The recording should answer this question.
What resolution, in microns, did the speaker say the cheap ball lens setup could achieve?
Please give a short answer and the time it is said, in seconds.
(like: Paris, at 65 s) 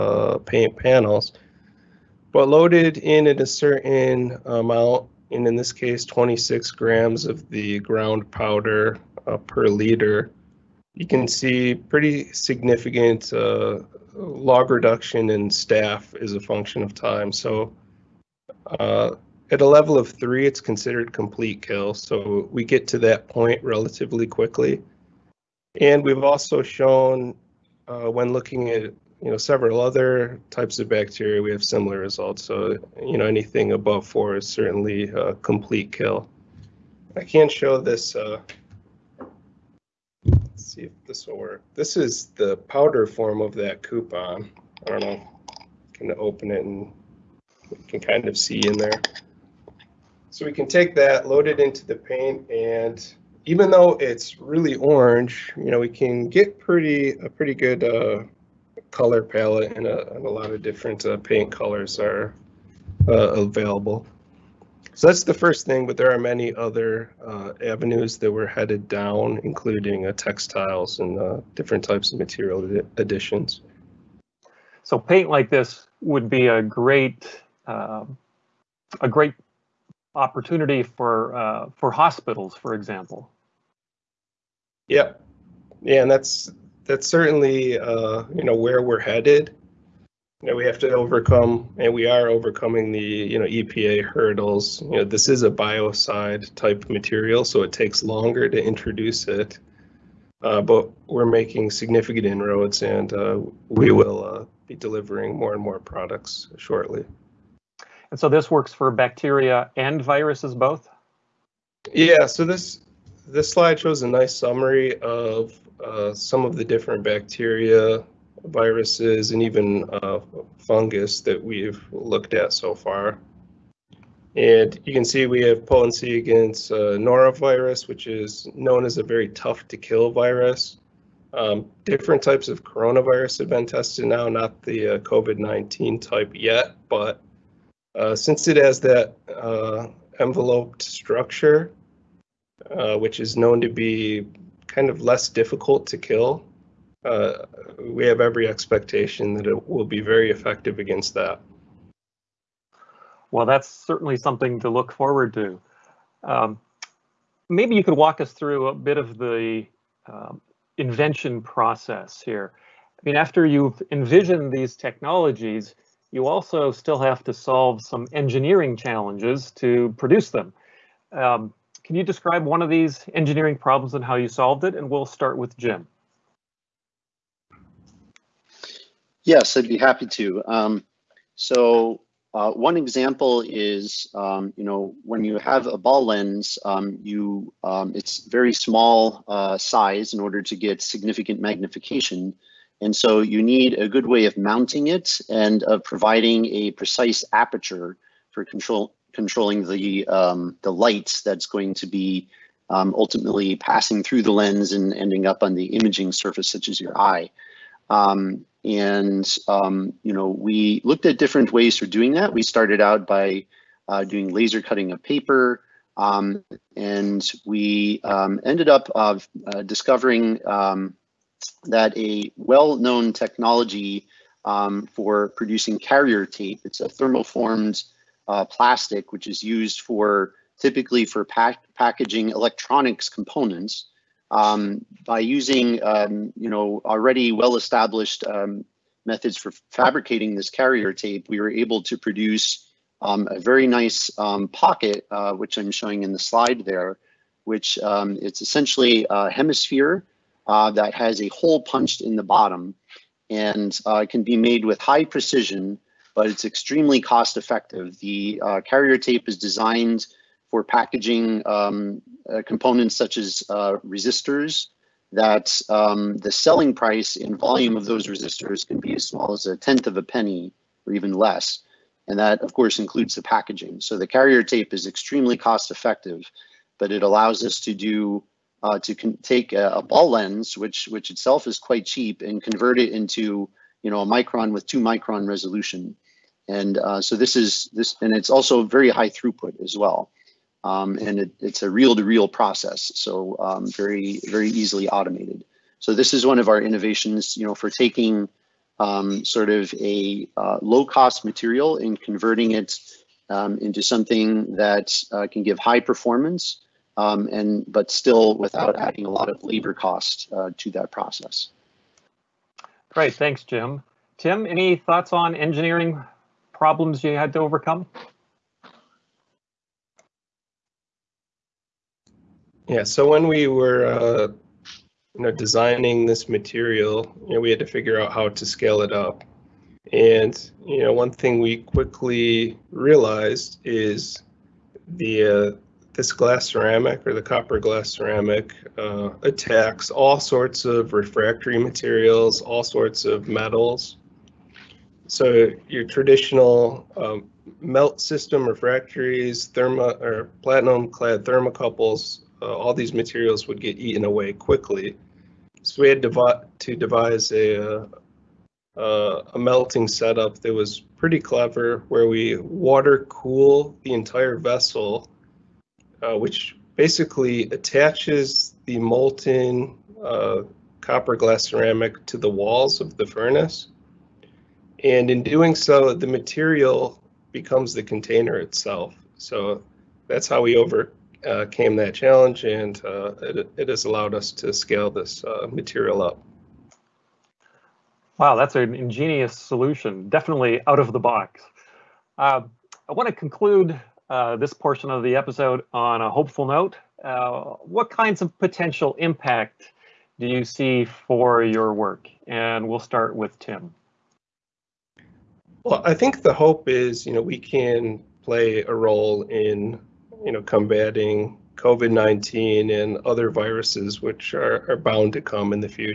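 2 micron, at 284 s.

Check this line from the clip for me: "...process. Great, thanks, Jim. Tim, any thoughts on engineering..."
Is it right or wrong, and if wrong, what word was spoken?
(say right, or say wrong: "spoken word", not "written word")
right.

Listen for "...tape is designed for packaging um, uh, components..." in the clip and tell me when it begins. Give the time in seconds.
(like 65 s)
258 s.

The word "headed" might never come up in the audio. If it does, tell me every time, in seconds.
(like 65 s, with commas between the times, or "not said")
68 s, 88 s.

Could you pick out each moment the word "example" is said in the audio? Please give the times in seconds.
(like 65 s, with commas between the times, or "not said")
82 s, 182 s.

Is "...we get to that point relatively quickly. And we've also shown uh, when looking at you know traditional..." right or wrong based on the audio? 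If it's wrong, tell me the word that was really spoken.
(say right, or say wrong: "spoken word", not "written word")
wrong: "several", not "traditional".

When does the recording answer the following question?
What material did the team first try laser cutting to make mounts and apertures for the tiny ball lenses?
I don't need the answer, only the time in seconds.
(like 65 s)
215 s.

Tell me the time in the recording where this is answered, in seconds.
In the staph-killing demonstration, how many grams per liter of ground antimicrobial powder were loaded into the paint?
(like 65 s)
6 s.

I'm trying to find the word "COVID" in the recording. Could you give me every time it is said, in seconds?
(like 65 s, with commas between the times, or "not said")
134 s, 411 s.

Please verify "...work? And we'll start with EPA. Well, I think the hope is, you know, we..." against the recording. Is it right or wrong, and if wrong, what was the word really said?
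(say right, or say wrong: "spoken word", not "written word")
wrong: "Tim", not "EPA".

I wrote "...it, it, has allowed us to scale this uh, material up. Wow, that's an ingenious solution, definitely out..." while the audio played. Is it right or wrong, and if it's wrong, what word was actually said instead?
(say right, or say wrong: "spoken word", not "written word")
right.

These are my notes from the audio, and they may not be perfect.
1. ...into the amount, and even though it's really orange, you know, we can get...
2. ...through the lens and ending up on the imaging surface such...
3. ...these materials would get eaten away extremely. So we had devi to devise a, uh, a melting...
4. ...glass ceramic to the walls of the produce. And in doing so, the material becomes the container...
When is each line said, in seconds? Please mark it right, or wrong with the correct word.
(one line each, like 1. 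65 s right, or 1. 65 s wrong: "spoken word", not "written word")
1. 51 s wrong: "paint", not "amount"
2. 204 s right
3. 352 s wrong: "quickly", not "extremely"
4. 371 s wrong: "furnace", not "produce".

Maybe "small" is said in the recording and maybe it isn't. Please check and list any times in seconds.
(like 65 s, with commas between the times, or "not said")
188 s, 269 s.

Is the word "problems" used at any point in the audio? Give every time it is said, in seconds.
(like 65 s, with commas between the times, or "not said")
173 s, 316 s.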